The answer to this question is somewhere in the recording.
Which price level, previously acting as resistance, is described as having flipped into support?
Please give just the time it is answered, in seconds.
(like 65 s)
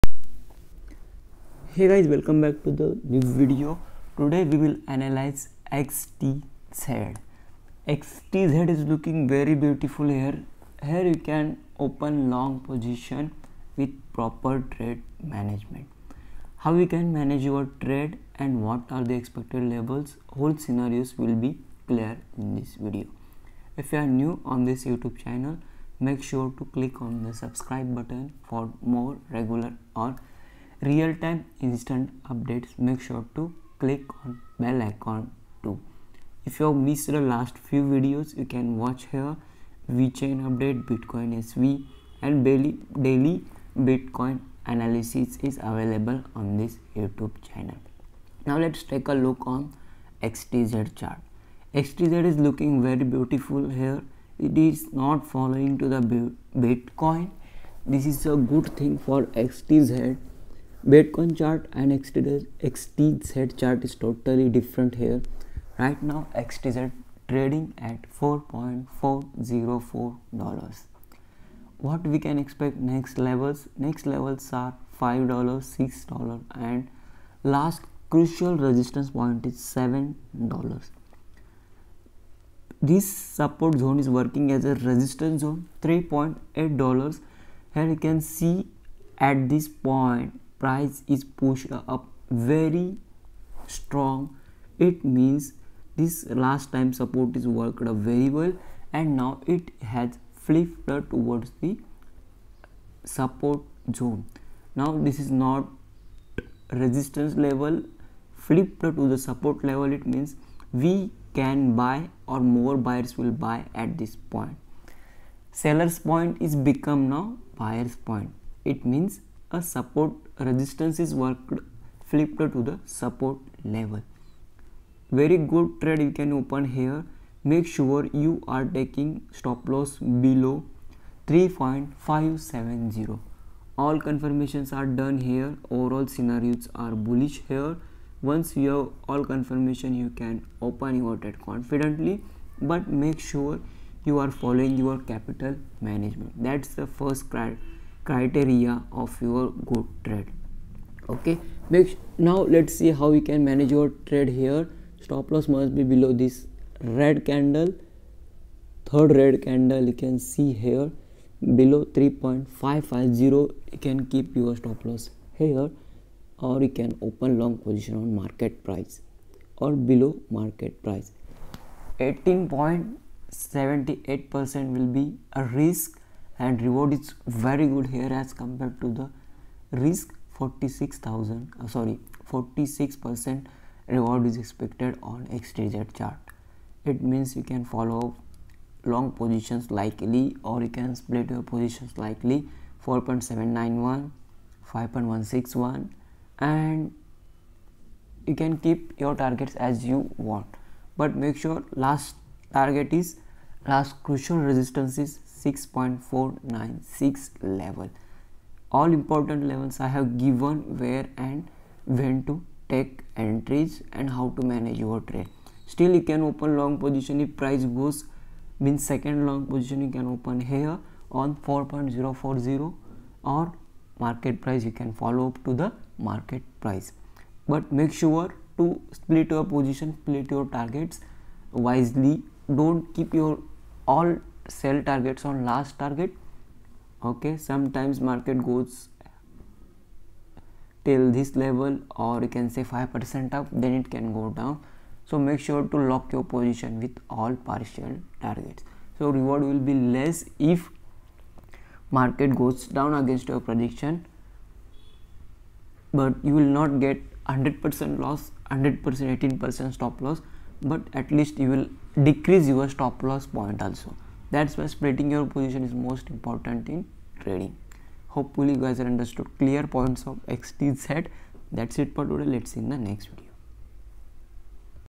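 85 s.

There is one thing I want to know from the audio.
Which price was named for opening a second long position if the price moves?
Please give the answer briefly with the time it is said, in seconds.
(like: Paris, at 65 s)
4.040, at 221 s.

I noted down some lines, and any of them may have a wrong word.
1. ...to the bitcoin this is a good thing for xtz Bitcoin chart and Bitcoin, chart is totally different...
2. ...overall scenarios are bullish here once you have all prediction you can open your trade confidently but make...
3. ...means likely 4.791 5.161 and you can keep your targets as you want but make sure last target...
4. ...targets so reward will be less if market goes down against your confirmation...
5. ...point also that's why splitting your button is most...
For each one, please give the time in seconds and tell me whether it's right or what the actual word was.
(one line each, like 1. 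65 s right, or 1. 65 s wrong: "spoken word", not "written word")
1. 55 s wrong: "XTZ", not "Bitcoin"
2. 135 s wrong: "confirmation", not "prediction"
3. 191 s wrong: "positions", not "means"
4. 248 s wrong: "prediction", not "confirmation"
5. 263 s wrong: "position", not "button".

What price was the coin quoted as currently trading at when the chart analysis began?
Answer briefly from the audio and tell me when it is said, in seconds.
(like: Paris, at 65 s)
$4.404, at 68 s.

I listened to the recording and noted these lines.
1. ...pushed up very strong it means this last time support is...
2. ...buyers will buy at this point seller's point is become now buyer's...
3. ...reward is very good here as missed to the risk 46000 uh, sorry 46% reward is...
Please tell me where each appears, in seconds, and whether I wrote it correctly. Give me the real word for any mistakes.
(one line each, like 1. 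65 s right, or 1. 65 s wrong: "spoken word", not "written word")
1. 91 s right
2. 112 s right
3. 176 s wrong: "compared", not "missed".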